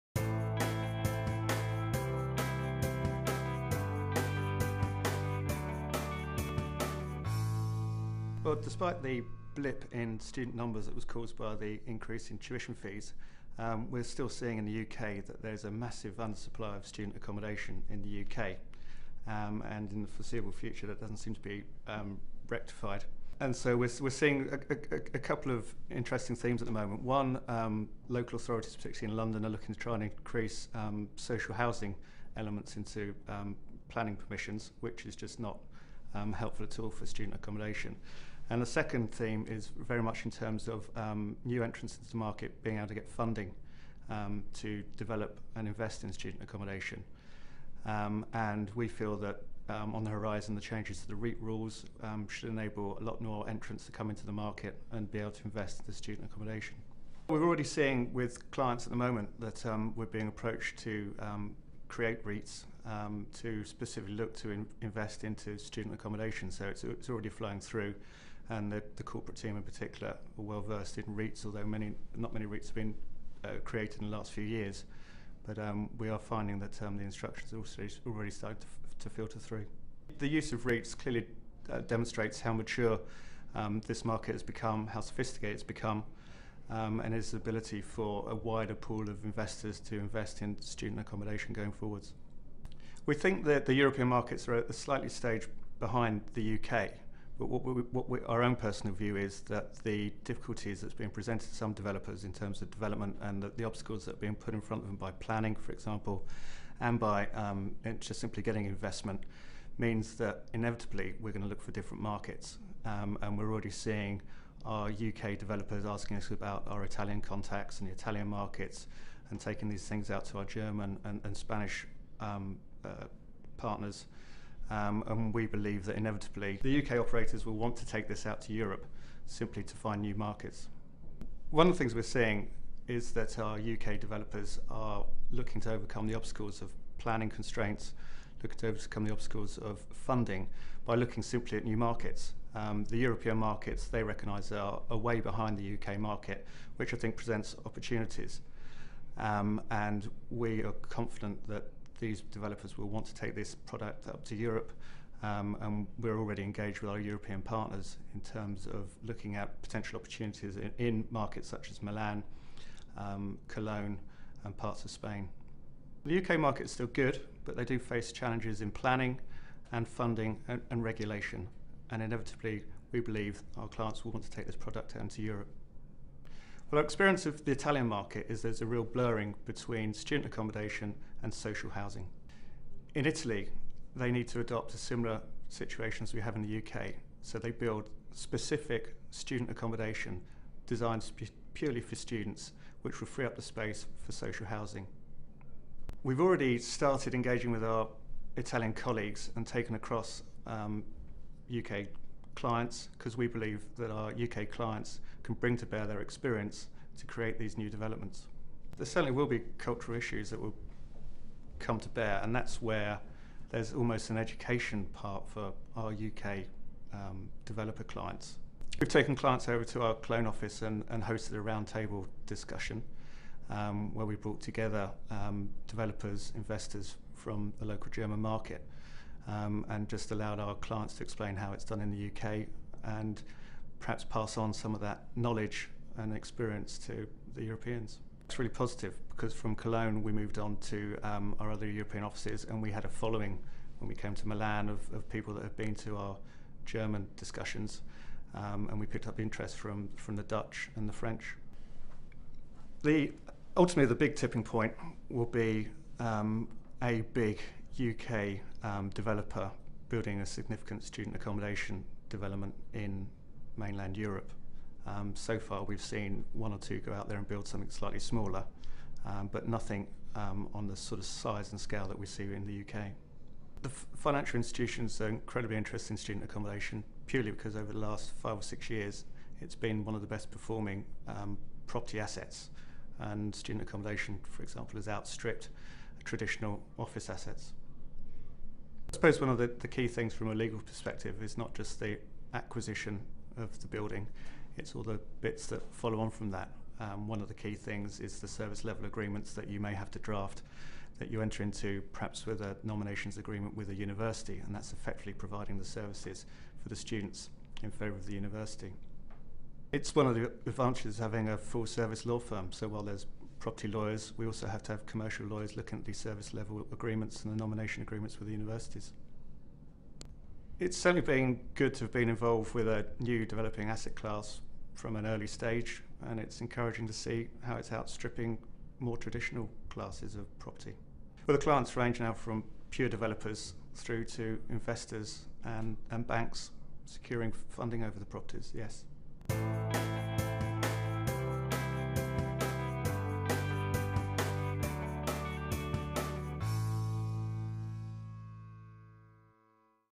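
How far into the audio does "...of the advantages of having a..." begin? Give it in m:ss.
5:10.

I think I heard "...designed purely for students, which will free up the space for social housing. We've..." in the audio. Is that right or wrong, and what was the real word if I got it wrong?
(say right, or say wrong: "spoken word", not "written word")
right.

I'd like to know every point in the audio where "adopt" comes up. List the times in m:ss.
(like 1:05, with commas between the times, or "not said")
3:04.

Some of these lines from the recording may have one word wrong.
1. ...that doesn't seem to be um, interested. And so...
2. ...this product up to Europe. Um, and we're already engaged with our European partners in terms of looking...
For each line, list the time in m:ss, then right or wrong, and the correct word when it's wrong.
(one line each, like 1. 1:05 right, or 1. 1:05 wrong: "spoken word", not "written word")
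1. 0:20 wrong: "rectified", not "interested"
2. 2:33 right.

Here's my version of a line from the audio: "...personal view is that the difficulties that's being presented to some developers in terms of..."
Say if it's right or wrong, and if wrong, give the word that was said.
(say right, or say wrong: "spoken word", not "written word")
right.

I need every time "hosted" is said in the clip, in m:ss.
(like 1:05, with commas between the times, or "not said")
3:41.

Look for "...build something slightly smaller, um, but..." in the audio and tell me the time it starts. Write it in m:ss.
4:27.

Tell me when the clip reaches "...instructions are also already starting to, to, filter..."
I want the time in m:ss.
1:17.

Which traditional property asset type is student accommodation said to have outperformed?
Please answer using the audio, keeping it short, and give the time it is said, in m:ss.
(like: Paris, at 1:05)
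office assets, at 4:46.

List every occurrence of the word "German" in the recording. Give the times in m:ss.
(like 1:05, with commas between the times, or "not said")
2:00, 3:47, 4:06.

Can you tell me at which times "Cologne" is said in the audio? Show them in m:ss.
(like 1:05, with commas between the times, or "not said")
2:43, 3:39, 3:59.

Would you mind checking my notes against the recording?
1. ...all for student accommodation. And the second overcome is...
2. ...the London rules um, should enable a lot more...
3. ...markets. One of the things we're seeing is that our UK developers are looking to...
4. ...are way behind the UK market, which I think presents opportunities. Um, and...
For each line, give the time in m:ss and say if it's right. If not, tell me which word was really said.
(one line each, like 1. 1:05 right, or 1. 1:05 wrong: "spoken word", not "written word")
1. 0:36 wrong: "theme", not "overcome"
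2. 0:51 wrong: "REIT", not "London"
3. 2:10 right
4. 2:24 right.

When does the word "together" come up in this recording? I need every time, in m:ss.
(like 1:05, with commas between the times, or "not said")
3:44.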